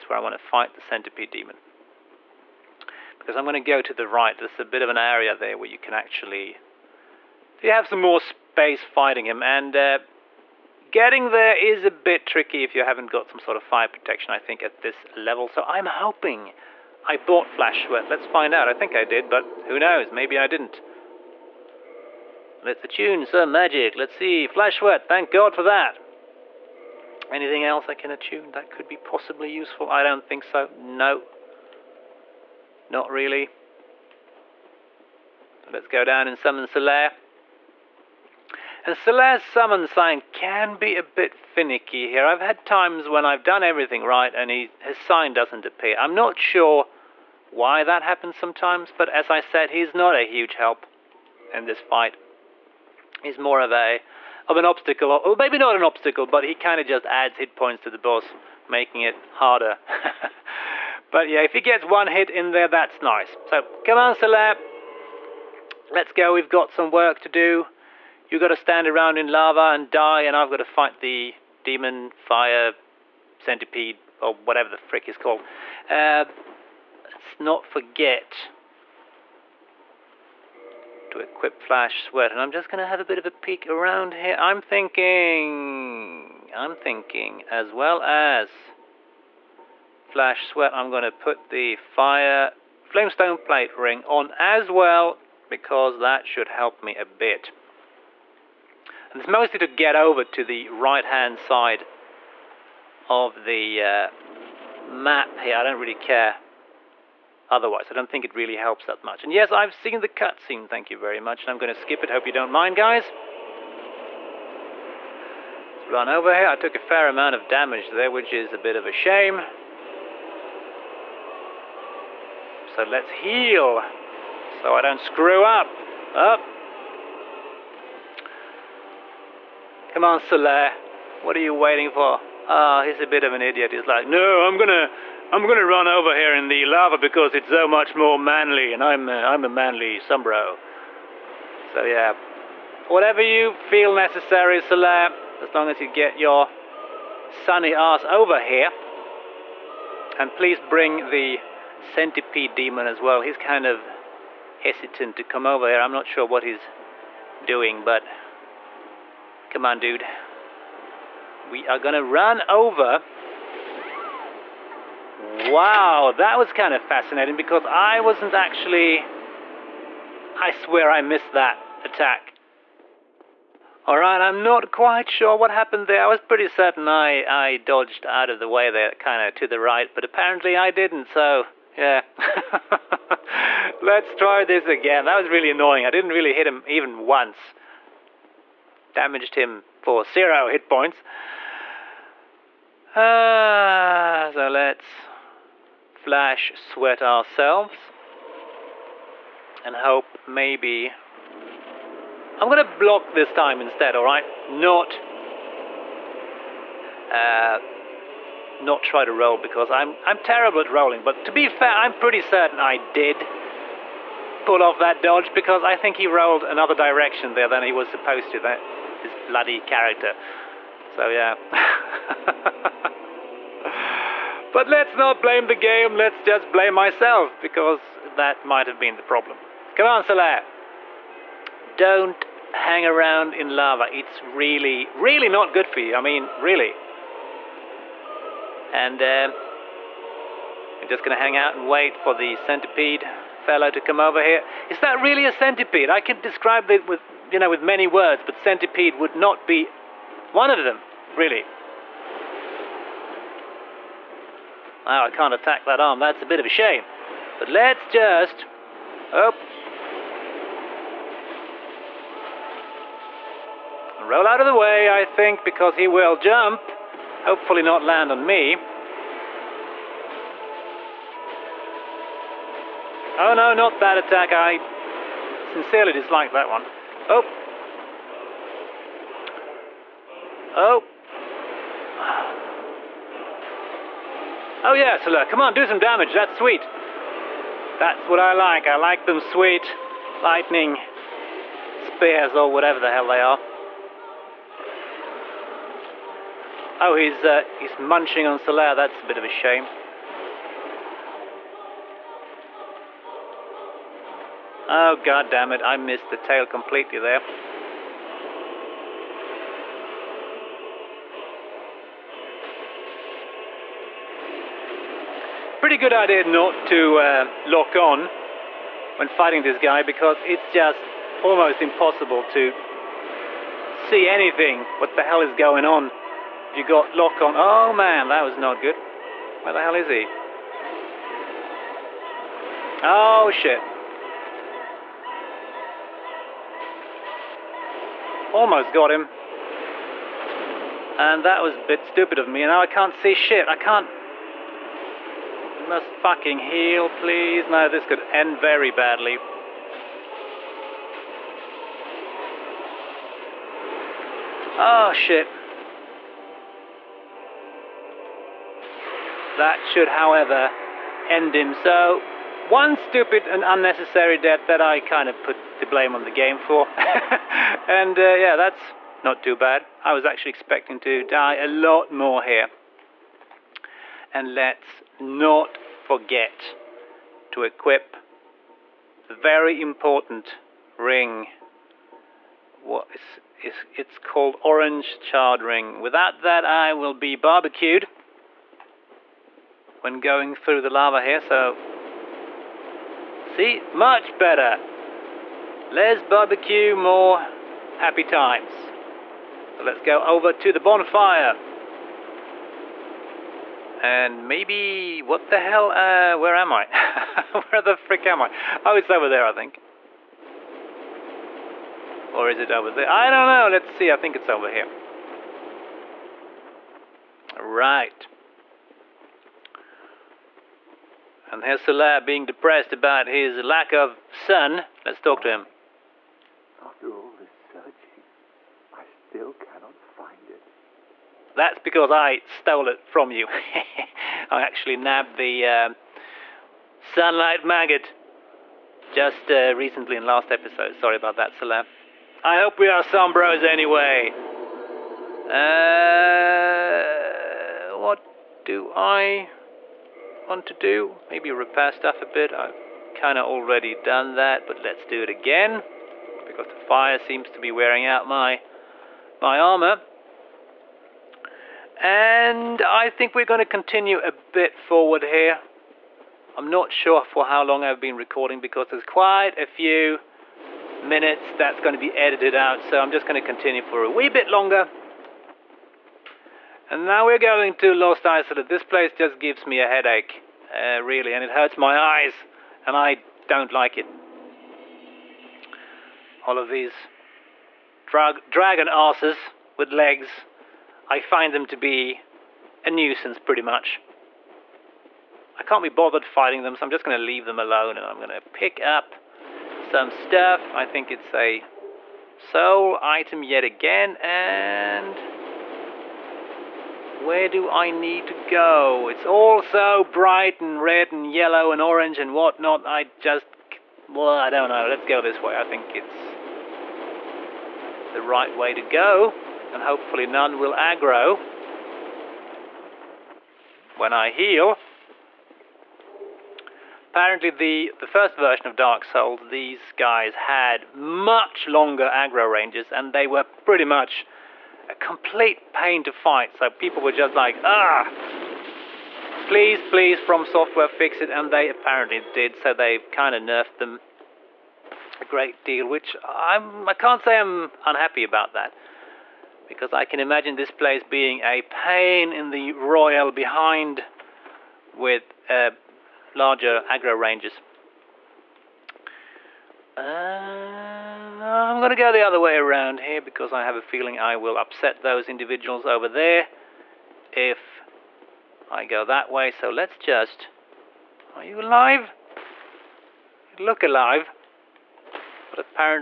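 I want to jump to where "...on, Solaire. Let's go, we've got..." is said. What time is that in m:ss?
1:03.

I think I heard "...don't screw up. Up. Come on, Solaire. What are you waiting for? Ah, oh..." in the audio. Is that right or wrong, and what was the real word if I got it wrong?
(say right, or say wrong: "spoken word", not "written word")
right.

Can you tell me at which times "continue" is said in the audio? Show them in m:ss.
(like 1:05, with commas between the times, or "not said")
7:43, 7:53.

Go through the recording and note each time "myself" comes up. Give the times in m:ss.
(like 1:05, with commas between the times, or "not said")
3:46.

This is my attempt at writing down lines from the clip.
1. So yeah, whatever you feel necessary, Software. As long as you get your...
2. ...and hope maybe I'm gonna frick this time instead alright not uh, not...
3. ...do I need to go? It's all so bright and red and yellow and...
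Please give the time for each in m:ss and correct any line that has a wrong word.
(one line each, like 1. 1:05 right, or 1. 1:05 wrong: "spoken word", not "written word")
1. 2:21 wrong: "Solaire", not "Software"
2. 3:19 wrong: "block", not "frick"
3. 8:27 right.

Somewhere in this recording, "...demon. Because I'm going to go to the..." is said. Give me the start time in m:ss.
0:01.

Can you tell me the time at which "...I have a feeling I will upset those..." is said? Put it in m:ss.
9:23.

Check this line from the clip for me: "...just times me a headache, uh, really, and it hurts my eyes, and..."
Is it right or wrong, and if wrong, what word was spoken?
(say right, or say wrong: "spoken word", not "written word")
wrong: "gives", not "times".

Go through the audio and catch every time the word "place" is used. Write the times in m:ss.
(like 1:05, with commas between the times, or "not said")
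7:58, 9:10.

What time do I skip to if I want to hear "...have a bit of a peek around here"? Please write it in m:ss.
1:22.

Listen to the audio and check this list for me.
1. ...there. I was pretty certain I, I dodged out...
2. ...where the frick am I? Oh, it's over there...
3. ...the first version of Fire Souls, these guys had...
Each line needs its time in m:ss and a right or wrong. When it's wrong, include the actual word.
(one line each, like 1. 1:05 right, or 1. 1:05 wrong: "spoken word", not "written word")
1. 2:55 right
2. 6:47 right
3. 8:47 wrong: "Dark", not "Fire".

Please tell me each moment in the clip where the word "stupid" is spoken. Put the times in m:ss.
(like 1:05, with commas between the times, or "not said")
5:41, 6:02.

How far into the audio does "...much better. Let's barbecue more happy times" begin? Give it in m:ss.
6:33.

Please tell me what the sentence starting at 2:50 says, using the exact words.
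I swear I missed that attack.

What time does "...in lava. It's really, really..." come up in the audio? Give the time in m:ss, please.
3:53.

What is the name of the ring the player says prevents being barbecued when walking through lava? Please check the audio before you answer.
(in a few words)
orange charred ring.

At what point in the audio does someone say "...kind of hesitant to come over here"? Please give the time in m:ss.
2:33.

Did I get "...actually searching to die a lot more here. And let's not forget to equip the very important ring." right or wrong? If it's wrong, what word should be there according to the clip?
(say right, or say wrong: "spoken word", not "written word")
wrong: "expecting", not "searching".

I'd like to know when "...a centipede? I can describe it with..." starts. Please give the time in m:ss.
4:05.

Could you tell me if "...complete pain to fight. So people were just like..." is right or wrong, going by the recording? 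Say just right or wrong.
right.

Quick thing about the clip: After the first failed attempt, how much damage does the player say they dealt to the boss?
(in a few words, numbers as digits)
zero.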